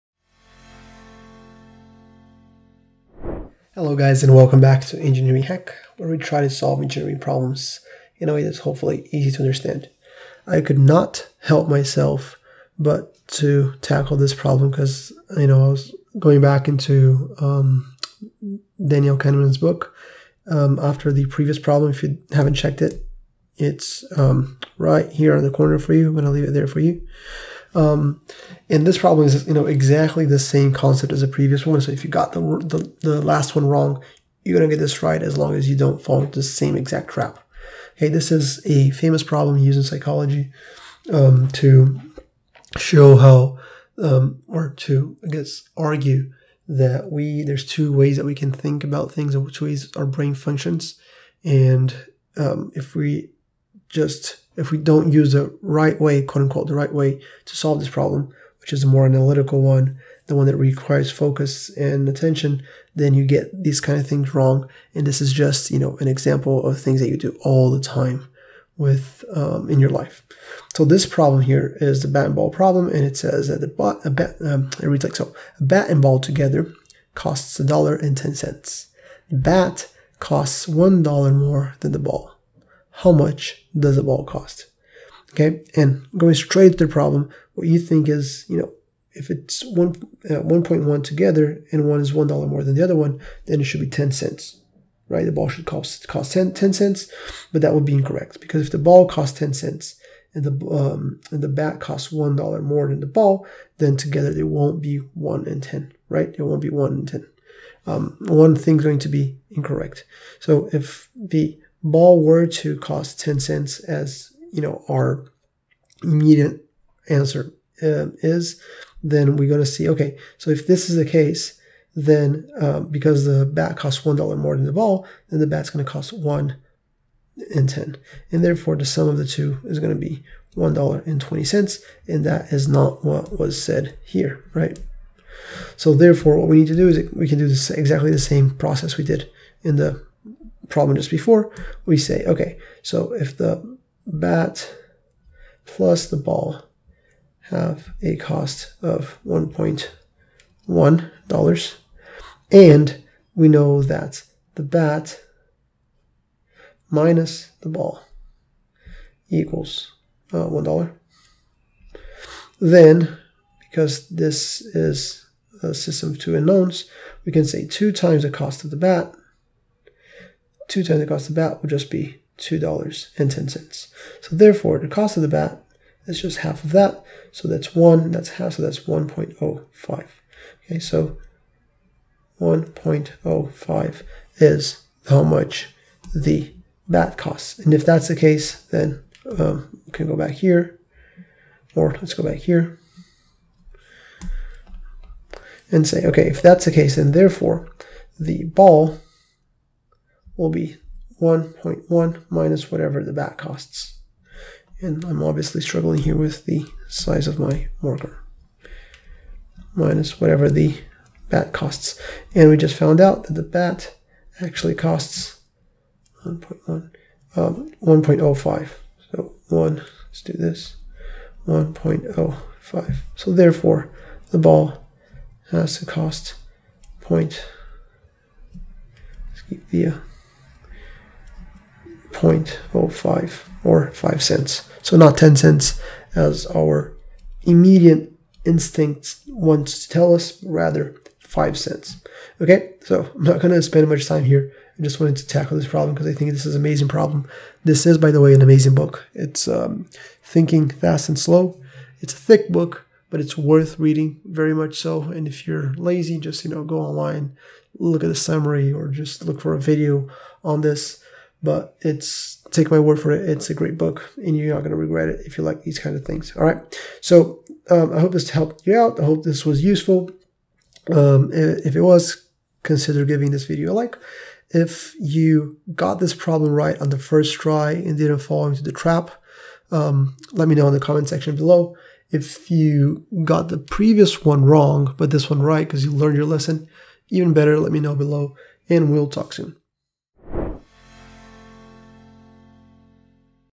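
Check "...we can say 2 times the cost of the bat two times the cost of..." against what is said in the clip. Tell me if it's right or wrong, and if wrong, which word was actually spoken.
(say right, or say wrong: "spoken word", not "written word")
right.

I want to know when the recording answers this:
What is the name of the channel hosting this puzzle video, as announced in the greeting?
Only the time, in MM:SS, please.
00:04.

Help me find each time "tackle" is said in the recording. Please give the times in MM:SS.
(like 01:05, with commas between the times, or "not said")
00:13, 04:05.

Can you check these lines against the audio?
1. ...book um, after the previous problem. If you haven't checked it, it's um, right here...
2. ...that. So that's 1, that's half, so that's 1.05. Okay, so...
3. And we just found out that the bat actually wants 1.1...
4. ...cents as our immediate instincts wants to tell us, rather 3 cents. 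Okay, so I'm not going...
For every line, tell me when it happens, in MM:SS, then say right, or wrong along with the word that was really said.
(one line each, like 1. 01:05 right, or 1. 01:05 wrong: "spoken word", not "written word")
1. 00:19 right
2. 02:56 right
3. 03:32 wrong: "costs", not "wants"
4. 03:55 wrong: "5", not "3".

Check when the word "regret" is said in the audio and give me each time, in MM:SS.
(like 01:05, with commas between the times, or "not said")
04:24.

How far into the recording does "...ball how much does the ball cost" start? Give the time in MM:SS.
01:21.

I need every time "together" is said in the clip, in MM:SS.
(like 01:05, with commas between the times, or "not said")
01:16, 01:31, 01:43.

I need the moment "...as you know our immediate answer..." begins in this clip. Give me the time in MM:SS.
01:53.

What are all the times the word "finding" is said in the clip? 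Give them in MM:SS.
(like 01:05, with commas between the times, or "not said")
not said.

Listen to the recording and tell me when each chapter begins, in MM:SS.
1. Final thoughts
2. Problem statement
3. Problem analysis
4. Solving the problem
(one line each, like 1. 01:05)
1. 03:54
2. 01:12
3. 01:25
4. 02:17.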